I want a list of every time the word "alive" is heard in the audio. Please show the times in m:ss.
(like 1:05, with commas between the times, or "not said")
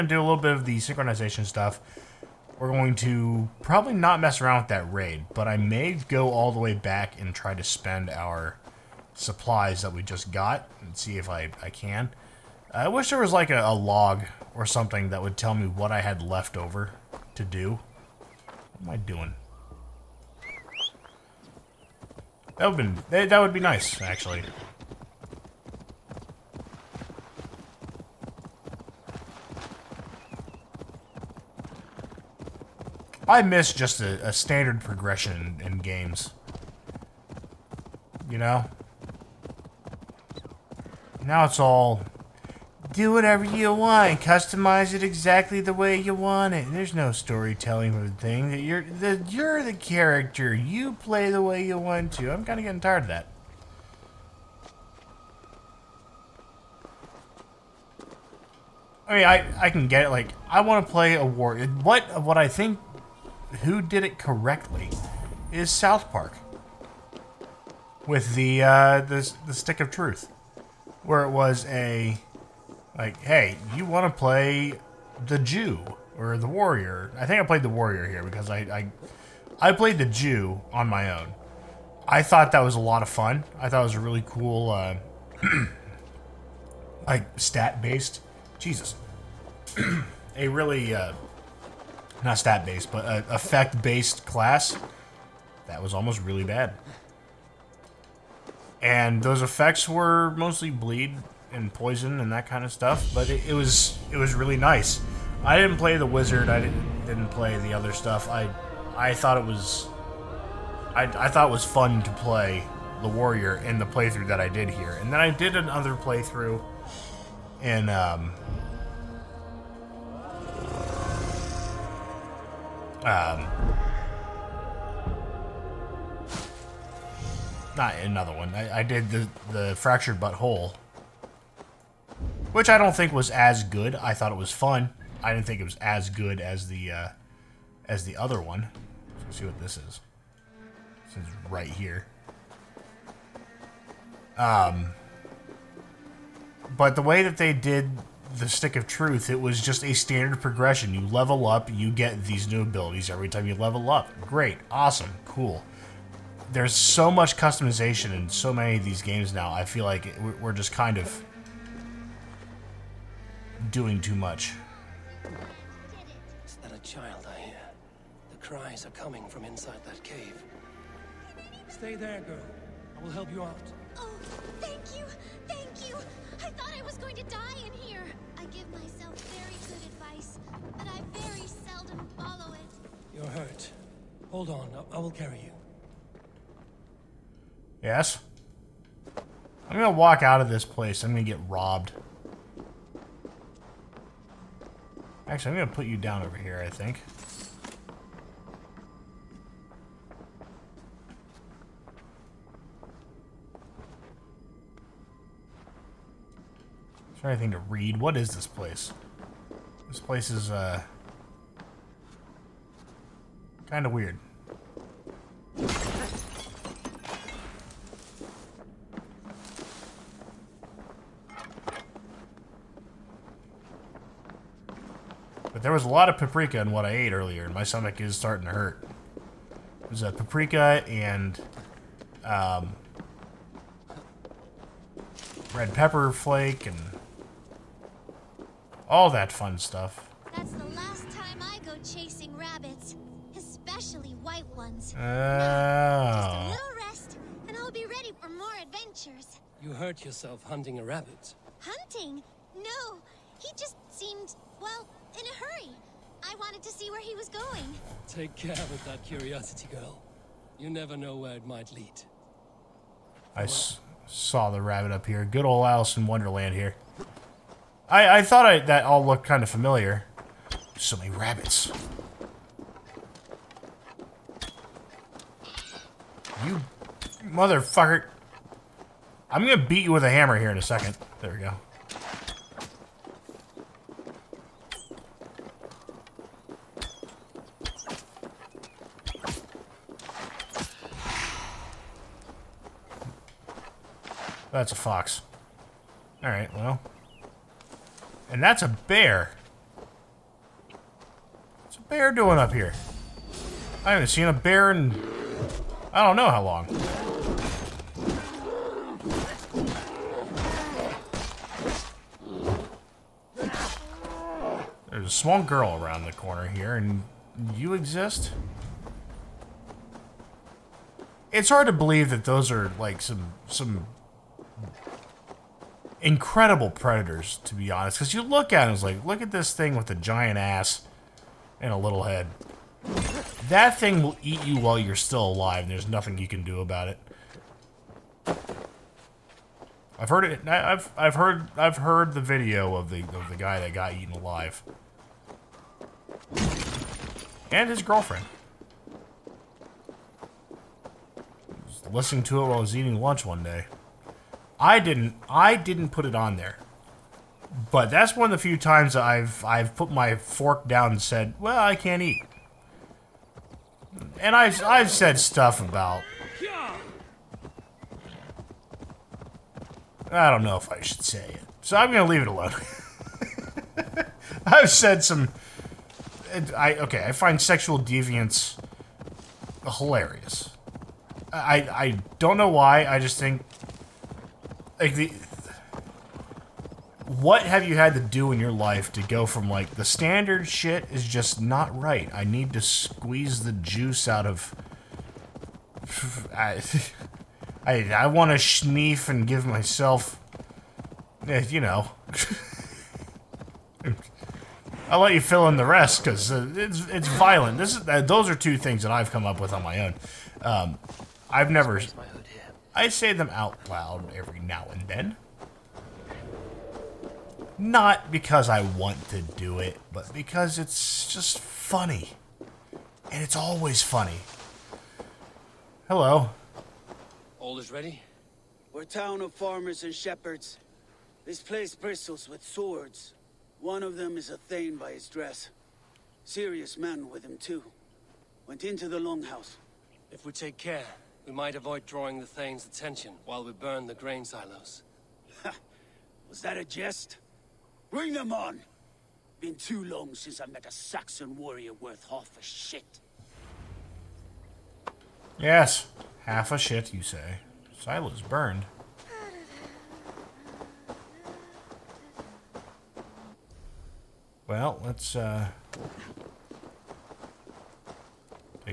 5:35, 5:44.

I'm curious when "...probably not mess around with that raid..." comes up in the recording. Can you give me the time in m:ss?
0:03.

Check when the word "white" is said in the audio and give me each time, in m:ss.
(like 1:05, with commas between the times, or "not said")
4:04.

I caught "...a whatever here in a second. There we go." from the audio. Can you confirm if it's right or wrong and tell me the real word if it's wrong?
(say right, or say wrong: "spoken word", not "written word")
wrong: "hammer", not "whatever".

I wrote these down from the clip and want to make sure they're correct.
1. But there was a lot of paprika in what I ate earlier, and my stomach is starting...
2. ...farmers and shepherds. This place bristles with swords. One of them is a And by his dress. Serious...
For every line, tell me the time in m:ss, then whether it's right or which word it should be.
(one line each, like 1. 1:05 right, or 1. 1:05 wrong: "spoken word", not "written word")
1. 3:45 right
2. 7:09 wrong: "Thane", not "And".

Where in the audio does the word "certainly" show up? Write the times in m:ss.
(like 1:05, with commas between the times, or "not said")
not said.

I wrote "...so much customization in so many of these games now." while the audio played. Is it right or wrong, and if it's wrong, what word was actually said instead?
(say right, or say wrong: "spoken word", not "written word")
right.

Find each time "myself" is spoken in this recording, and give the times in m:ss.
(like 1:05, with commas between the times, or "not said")
2:58, 6:39.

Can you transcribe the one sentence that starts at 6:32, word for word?
I need to squeeze the juice out of.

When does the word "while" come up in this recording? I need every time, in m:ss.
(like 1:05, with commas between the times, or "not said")
5:34, 5:52, 7:23.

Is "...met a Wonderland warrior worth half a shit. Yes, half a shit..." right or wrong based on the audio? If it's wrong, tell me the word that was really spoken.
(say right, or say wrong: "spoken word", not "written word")
wrong: "Saxon", not "Wonderland".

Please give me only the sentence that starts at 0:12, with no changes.
I wish there was like a, a log or something that would tell me what I had left over to do.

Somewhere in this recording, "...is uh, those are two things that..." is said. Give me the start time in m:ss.
6:47.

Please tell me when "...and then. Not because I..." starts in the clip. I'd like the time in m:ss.
6:54.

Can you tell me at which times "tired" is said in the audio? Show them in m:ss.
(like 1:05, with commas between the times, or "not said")
0:52.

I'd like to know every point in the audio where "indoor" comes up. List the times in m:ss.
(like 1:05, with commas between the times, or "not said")
not said.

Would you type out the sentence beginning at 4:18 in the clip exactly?
Take care with that curiosity, girl.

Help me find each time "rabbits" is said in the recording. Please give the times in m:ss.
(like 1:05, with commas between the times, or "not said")
4:02, 4:10, 4:24, 4:31.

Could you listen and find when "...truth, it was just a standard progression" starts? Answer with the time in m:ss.
2:28.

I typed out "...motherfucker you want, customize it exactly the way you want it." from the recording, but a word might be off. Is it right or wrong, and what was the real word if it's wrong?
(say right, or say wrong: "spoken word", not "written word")
wrong: "whatever", not "motherfucker".